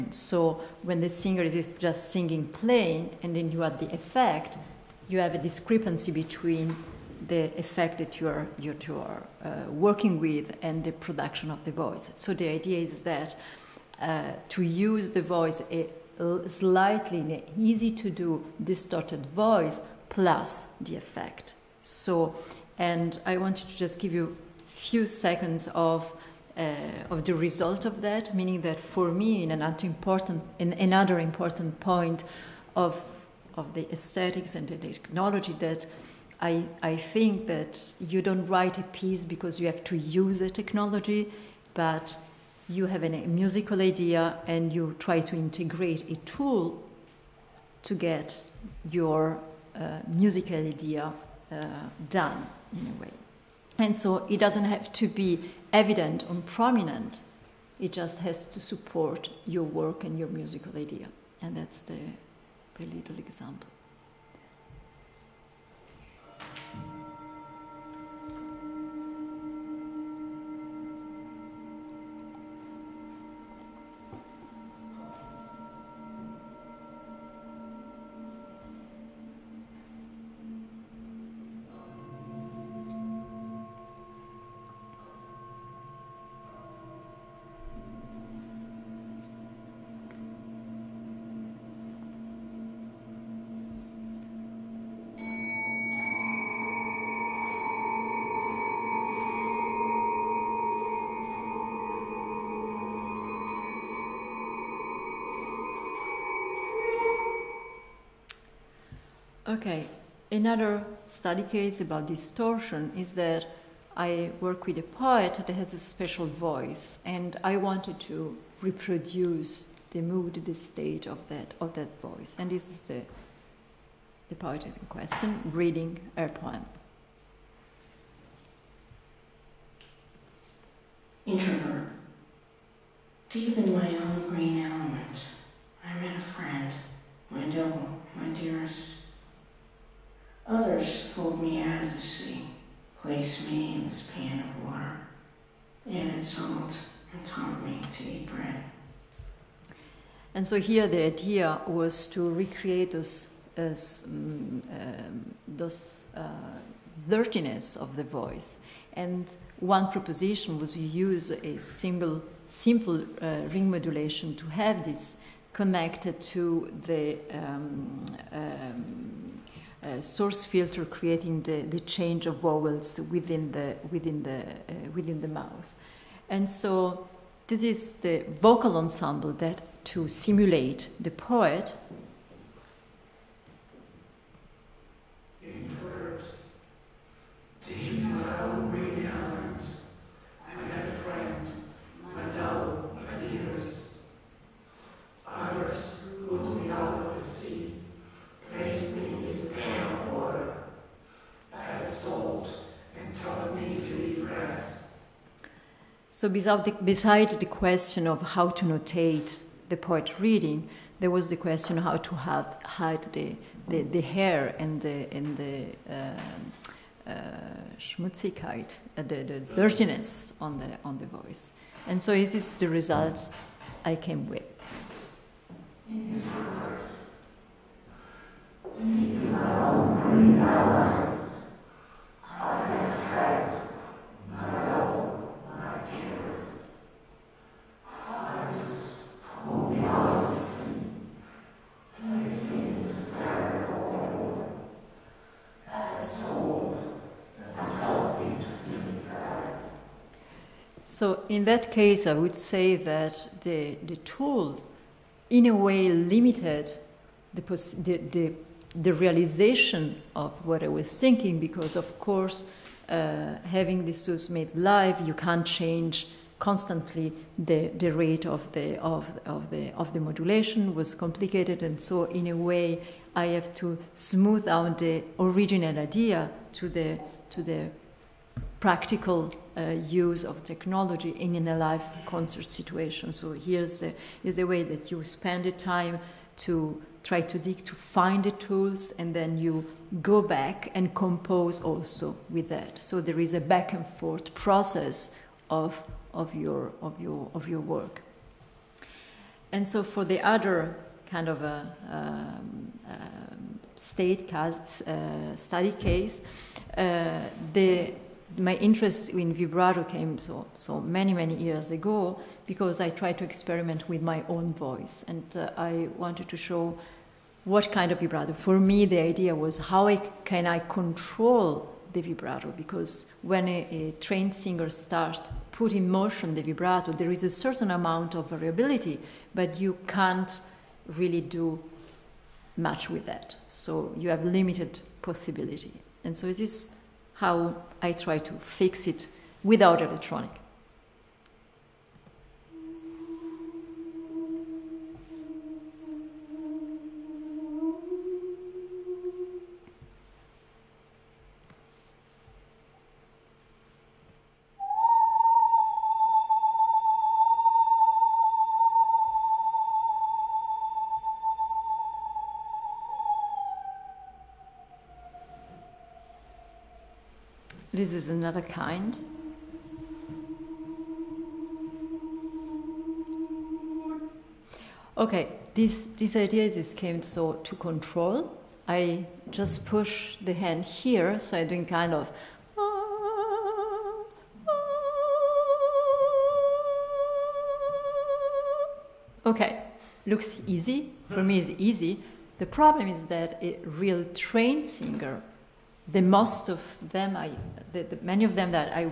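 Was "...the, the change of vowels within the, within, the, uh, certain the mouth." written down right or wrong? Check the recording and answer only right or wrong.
wrong.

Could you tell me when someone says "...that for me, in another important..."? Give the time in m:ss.
0:28.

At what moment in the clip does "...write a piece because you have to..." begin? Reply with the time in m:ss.
0:38.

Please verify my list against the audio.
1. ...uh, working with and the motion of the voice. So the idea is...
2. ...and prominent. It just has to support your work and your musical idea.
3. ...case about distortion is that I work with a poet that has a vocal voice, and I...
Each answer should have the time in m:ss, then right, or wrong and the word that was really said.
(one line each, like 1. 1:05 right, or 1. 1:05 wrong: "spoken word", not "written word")
1. 0:09 wrong: "production", not "motion"
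2. 0:56 right
3. 1:51 wrong: "special", not "vocal".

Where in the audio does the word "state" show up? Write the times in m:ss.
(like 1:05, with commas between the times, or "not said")
2:00, 5:03.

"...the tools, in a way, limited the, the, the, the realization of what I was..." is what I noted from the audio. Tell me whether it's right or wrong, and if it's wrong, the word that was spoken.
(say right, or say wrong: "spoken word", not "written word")
right.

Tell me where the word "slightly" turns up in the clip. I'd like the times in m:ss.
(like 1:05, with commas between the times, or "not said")
0:16.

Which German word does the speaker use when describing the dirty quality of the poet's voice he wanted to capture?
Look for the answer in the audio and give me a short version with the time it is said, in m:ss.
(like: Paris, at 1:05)
Schmutzigkeit, at 3:37.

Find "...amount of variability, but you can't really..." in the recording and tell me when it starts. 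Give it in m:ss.
5:27.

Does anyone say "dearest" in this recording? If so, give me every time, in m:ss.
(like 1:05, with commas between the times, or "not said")
2:18.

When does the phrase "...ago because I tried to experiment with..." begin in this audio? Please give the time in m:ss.
5:11.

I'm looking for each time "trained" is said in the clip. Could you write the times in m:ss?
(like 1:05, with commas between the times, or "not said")
5:24, 6:34.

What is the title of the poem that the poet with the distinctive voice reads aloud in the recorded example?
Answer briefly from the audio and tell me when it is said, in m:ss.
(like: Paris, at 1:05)
Introvert, at 2:11.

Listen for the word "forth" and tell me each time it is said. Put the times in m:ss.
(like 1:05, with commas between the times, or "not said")
4:53.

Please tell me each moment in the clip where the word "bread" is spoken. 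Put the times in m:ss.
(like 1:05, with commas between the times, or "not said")
2:28.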